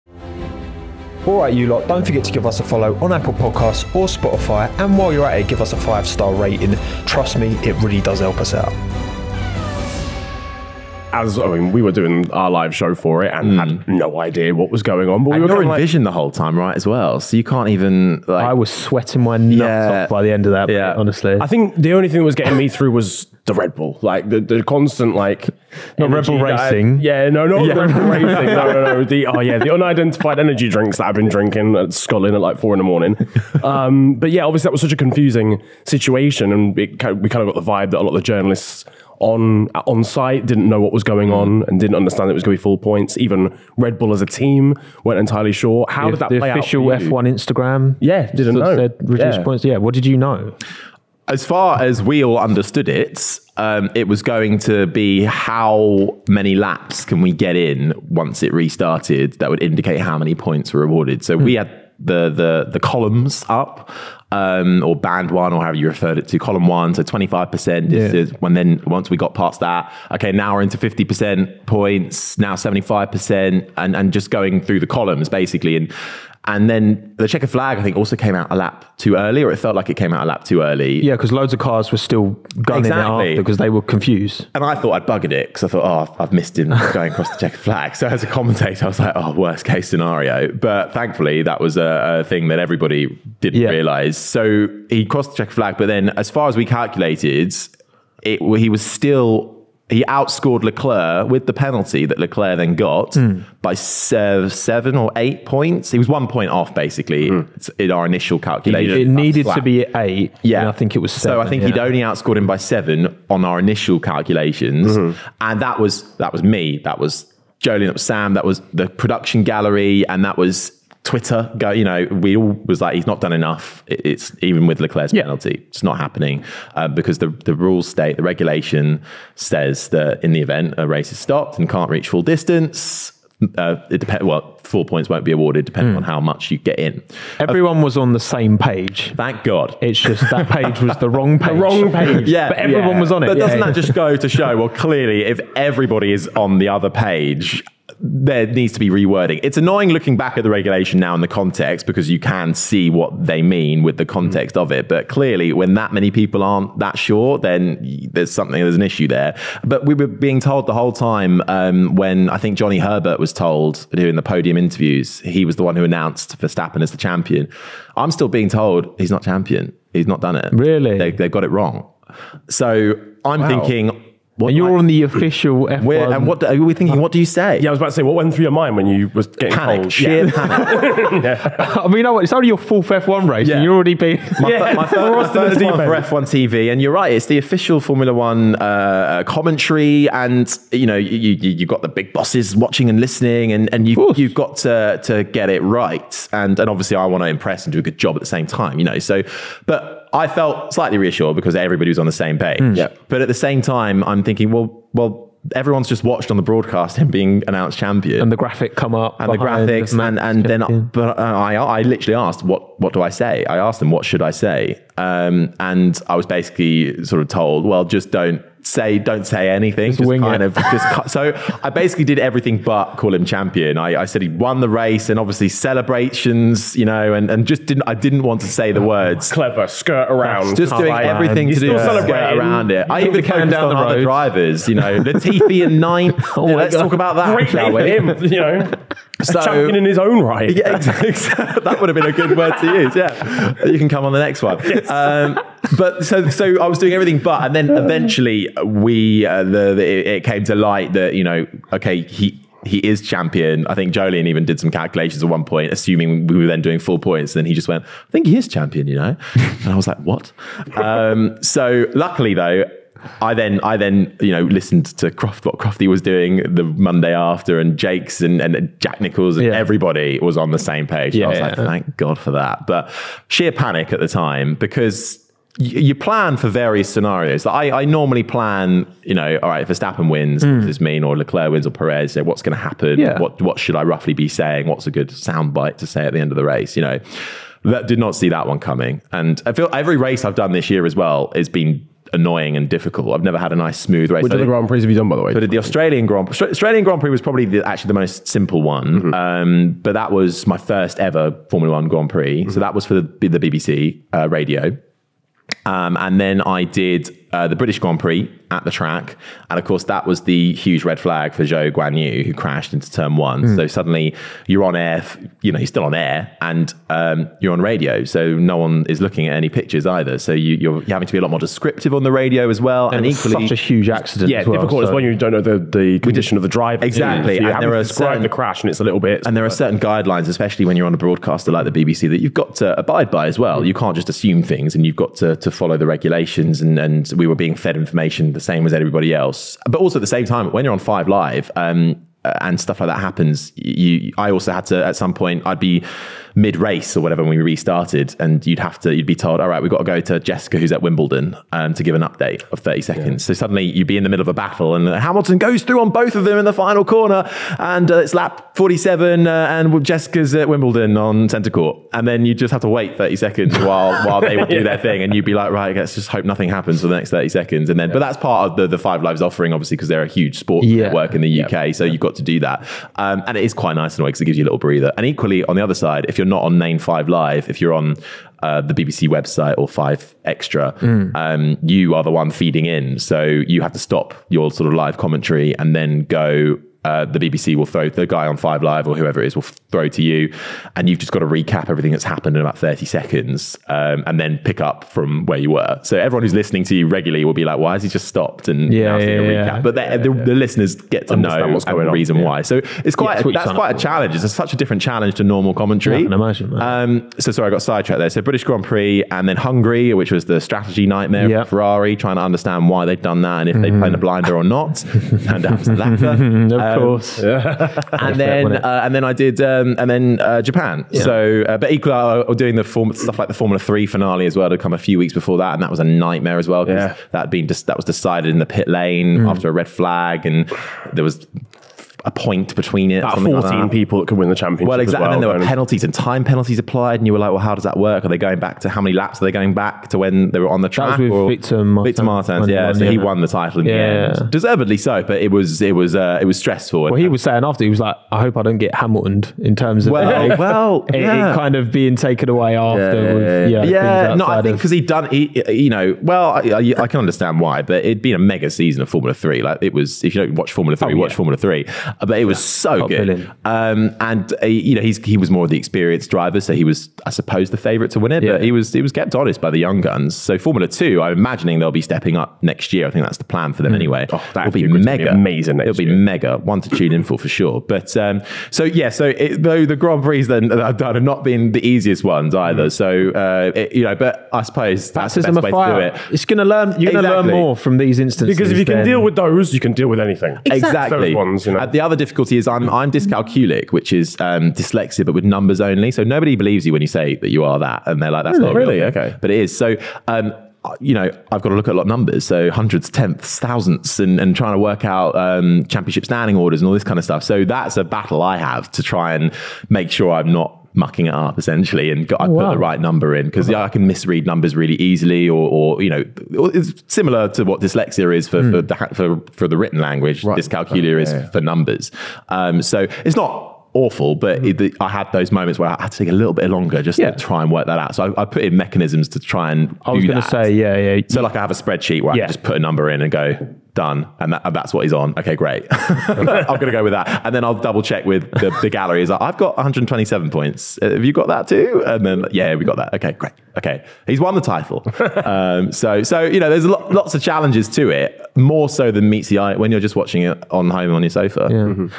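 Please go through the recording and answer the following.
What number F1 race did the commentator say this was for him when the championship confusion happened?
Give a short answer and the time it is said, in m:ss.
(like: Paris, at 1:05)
4th, at 3:02.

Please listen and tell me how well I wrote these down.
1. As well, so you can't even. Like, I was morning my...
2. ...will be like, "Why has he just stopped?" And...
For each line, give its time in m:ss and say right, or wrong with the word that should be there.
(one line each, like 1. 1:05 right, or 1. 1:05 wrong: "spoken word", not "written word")
1. 0:16 wrong: "sweating", not "morning"
2. 6:37 right.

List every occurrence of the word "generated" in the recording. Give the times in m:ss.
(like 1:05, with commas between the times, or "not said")
not said.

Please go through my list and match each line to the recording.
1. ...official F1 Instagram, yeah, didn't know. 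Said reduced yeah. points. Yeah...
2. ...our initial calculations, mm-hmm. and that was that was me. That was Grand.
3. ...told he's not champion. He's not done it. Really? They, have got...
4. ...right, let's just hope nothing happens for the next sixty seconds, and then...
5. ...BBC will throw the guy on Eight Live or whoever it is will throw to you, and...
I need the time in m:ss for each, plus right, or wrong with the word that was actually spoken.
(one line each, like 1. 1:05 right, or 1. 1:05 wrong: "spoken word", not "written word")
1. 0:46 right
2. 1:53 wrong: "Jolyon", not "Grand"
3. 2:48 right
4. 6:05 wrong: "thirty", not "sixty"
5. 6:27 wrong: "Five", not "Eight".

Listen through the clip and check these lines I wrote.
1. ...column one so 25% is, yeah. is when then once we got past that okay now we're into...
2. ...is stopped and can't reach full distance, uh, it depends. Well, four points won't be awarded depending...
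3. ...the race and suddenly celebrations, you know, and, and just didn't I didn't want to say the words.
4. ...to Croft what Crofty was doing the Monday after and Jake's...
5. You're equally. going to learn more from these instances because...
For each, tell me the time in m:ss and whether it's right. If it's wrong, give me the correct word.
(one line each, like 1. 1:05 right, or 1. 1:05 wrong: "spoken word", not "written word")
1. 1:06 right
2. 2:11 right
3. 3:44 wrong: "obviously", not "suddenly"
4. 4:24 right
5. 8:06 wrong: "exactly", not "equally".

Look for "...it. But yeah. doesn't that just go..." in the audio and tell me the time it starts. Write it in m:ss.
2:23.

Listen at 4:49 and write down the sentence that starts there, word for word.
And I feel every race I've done this year as well has been annoying and difficult.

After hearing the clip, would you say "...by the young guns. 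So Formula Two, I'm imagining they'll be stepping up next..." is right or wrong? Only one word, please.
right.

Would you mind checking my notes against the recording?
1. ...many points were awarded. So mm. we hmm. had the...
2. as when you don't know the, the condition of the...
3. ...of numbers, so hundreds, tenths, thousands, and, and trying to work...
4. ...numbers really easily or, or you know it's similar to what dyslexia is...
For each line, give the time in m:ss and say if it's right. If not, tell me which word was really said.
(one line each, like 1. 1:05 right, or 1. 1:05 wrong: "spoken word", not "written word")
1. 1:00 right
2. 5:24 right
3. 8:21 right
4. 8:34 right.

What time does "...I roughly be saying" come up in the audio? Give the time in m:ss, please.
4:43.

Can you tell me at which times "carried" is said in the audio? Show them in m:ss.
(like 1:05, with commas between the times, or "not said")
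not said.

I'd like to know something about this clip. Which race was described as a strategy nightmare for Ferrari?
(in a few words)
Hungary.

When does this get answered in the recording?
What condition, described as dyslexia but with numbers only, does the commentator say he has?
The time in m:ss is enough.
8:12.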